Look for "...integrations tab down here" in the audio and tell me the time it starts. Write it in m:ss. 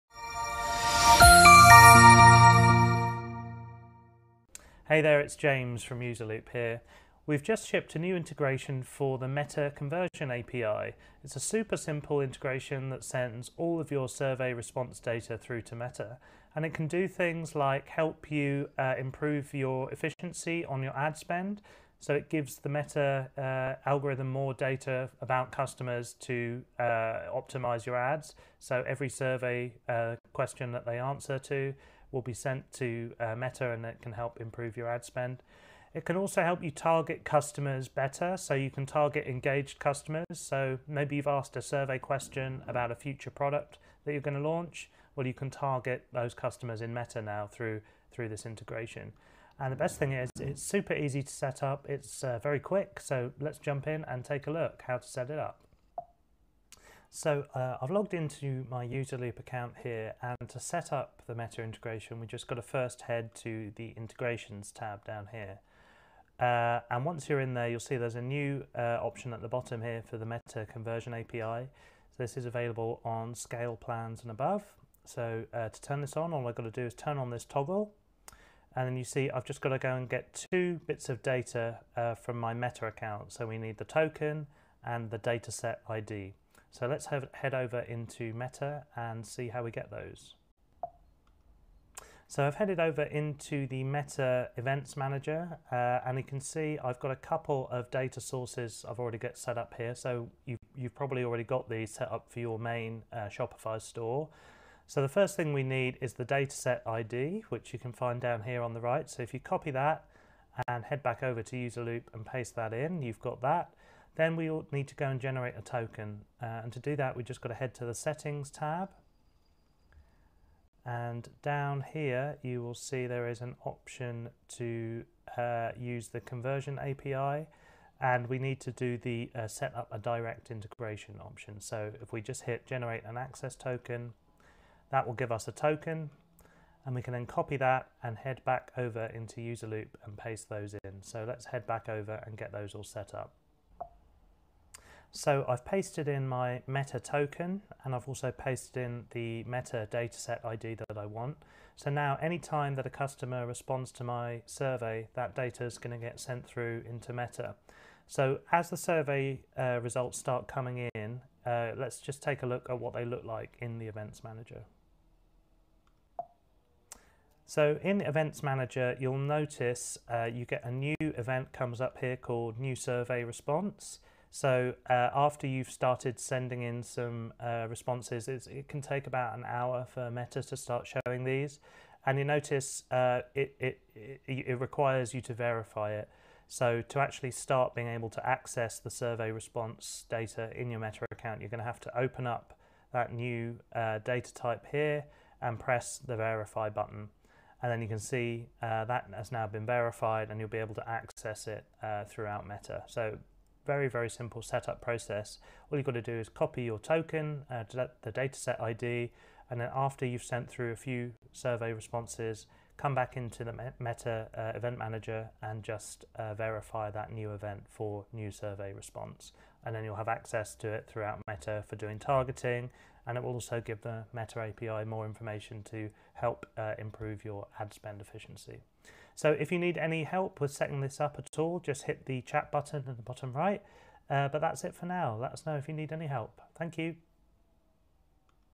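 1:03.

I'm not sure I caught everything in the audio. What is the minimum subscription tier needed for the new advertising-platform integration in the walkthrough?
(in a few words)
Scale plans.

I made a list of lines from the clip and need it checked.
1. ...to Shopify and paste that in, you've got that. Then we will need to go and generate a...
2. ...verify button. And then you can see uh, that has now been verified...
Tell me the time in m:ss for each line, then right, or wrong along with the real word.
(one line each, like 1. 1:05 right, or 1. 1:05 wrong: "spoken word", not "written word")
1. 1:51 wrong: "UserLoop", not "Shopify"
2. 3:16 right.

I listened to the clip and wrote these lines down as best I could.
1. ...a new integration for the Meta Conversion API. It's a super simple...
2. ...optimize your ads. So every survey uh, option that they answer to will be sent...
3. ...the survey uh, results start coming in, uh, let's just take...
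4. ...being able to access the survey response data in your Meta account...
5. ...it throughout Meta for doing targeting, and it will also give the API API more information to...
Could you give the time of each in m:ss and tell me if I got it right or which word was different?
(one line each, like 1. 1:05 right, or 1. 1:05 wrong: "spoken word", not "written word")
1. 0:07 right
2. 0:27 wrong: "question", not "option"
3. 2:38 right
4. 3:07 right
5. 3:40 wrong: "Meta", not "API".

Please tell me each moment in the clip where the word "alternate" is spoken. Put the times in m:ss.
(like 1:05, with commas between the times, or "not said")
not said.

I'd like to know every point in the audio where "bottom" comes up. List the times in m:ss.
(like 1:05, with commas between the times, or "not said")
1:09, 3:53.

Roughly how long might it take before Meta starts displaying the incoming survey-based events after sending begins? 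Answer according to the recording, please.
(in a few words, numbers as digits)
About an hour.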